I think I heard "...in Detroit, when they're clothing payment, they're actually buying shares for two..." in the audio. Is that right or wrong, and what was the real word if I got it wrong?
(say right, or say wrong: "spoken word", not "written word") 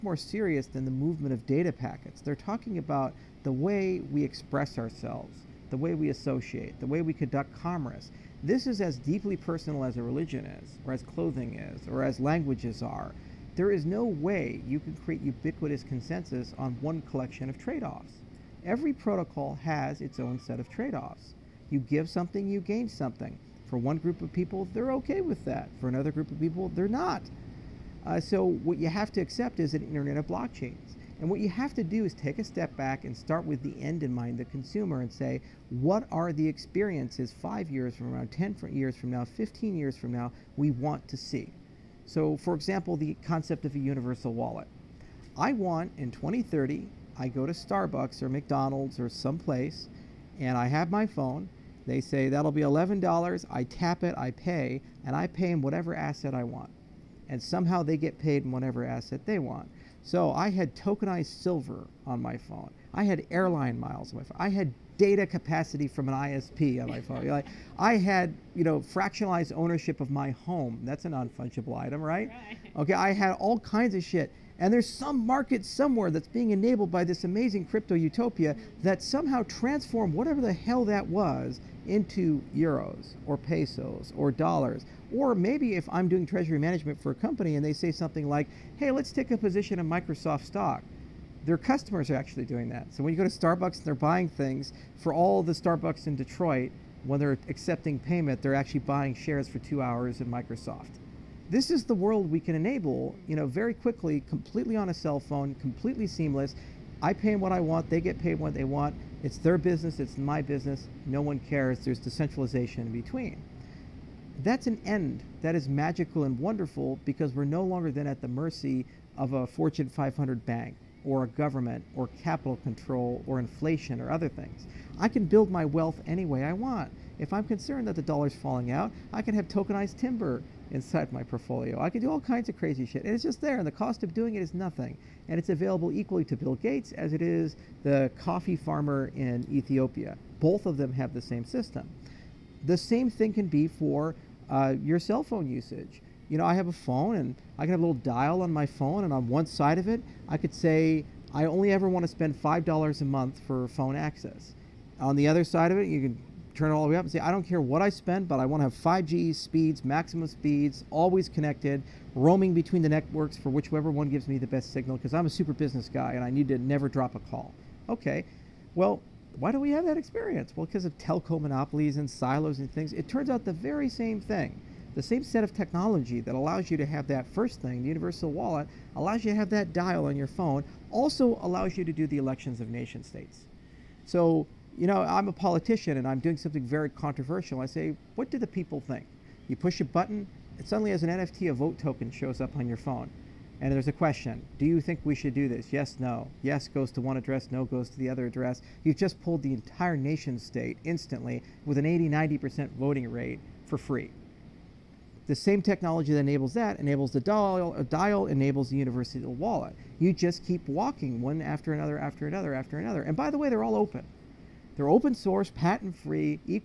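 wrong: "accepting", not "clothing".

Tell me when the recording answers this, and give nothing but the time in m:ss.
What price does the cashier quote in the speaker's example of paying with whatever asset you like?
0:52.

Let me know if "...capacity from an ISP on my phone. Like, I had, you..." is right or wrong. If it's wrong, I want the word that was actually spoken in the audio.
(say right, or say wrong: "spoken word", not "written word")
right.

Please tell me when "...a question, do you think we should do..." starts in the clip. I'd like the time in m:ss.
3:13.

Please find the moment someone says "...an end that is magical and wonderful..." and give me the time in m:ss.
1:54.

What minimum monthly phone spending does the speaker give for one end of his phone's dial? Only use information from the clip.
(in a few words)
$5.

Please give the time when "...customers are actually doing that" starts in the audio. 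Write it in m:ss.
1:31.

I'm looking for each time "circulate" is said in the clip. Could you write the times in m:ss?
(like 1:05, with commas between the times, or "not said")
not said.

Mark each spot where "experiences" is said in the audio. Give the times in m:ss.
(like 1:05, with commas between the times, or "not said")
0:36, 2:49.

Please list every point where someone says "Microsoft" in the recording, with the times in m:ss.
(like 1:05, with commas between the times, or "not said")
1:29, 1:40.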